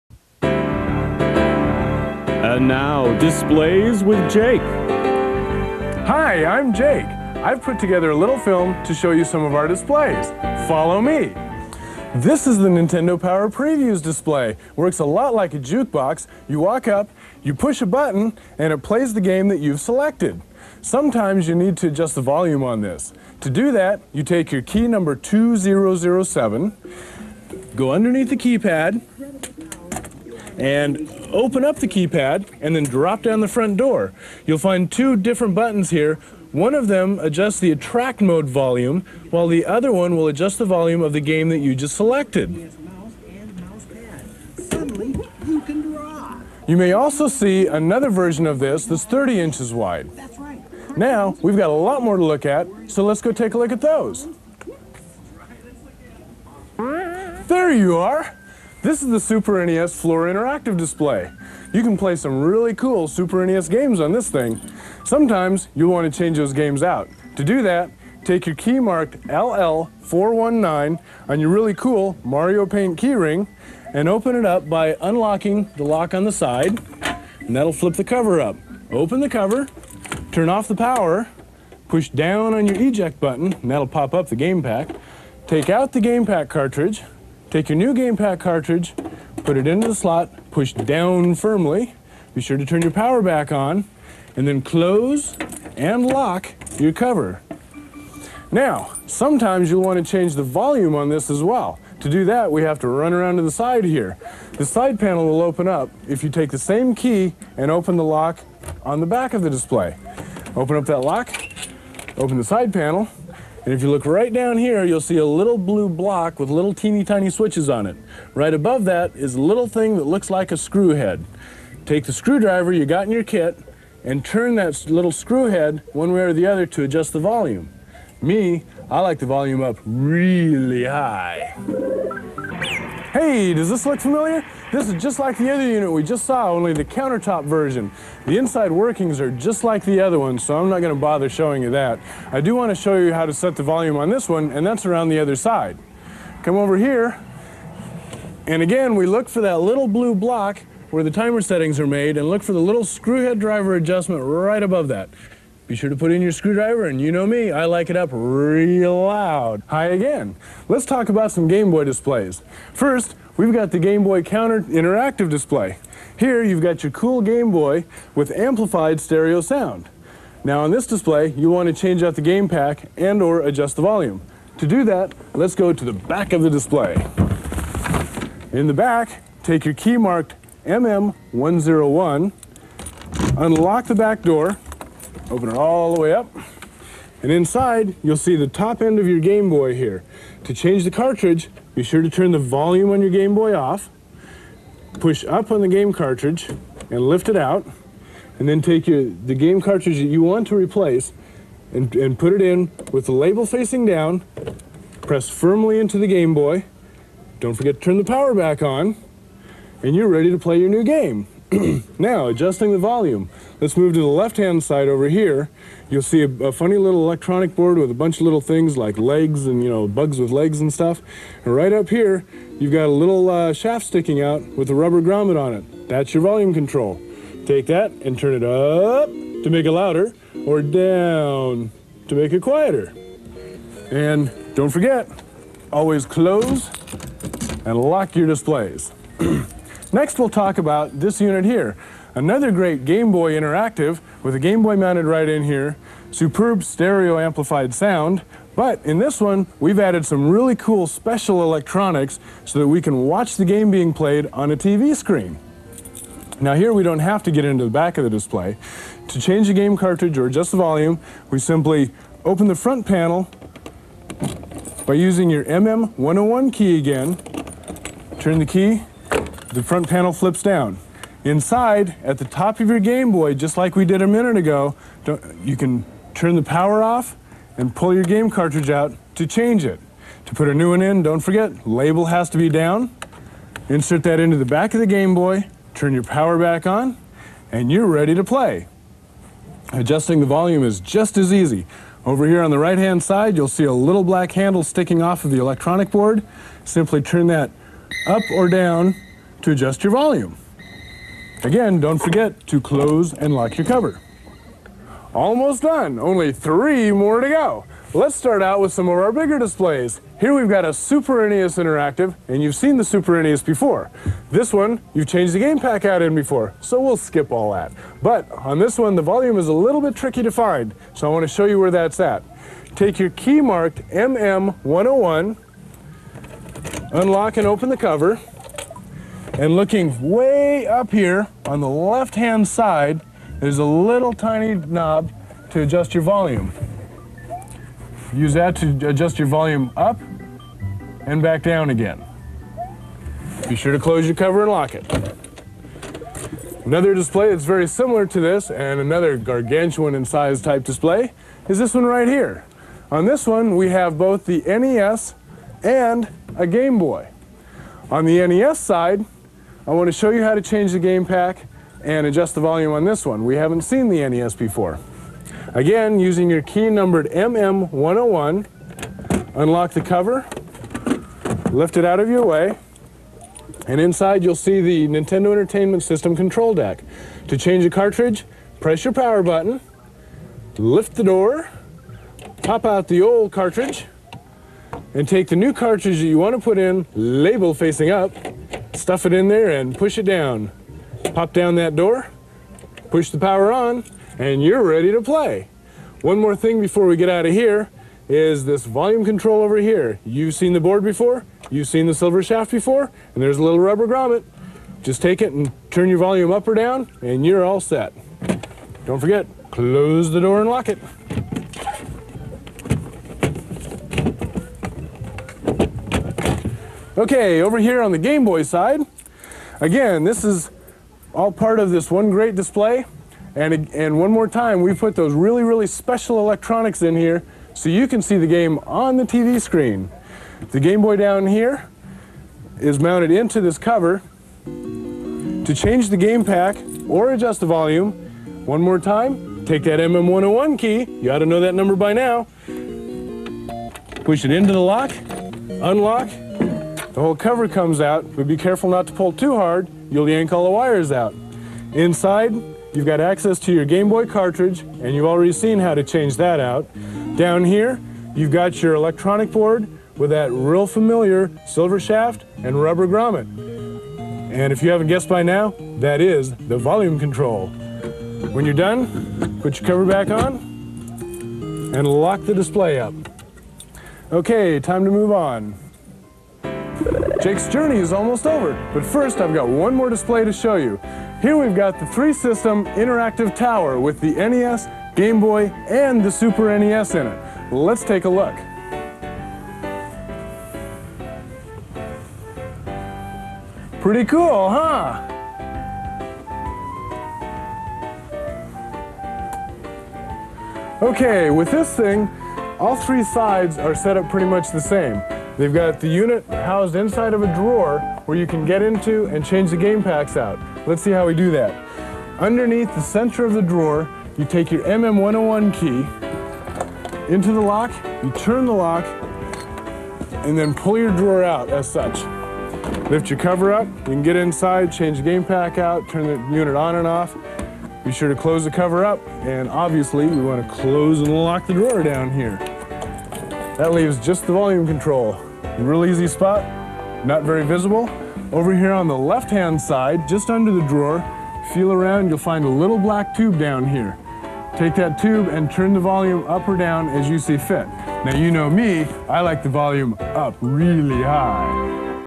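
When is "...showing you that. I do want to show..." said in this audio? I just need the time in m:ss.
2:21.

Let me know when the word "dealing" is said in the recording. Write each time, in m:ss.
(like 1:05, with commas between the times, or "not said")
not said.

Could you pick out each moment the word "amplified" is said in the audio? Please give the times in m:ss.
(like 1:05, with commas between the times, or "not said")
2:48, 4:07.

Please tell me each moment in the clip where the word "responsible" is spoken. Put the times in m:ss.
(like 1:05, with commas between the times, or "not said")
not said.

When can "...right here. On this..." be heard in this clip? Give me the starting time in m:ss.
5:51.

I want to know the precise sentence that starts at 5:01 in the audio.
Again, don't forget to close and lock your cover.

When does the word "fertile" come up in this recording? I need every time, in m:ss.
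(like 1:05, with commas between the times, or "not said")
not said.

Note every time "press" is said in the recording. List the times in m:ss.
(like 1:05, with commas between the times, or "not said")
3:25, 6:18.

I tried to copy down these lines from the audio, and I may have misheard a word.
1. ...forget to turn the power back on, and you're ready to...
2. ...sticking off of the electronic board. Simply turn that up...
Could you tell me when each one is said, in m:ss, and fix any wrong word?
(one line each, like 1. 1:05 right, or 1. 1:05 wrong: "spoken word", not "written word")
1. 3:27 right
2. 4:54 right.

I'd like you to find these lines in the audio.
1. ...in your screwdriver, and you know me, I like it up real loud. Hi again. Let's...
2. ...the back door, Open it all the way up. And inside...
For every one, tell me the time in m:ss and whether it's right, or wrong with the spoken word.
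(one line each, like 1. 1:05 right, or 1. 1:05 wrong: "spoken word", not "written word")
1. 2:36 right
2. 3:03 right.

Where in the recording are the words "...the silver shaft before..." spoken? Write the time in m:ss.
6:41.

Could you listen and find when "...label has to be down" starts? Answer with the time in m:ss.
4:41.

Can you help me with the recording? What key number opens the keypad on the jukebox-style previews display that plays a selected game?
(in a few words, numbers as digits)
2007.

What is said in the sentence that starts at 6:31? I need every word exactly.
Pop down that door, push the power on, and you're ready to play.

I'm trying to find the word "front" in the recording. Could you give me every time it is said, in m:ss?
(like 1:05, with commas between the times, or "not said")
0:33, 4:22, 4:29.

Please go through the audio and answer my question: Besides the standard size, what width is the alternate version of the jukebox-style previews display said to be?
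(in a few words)
30 inches.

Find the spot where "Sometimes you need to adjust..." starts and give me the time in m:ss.
0:20.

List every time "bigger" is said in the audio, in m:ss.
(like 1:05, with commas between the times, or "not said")
5:09.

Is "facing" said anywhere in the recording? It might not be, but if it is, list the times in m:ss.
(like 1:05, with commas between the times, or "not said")
3:23, 6:27.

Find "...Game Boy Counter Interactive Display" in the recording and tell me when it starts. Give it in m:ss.
2:43.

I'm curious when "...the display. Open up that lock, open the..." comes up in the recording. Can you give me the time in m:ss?
1:49.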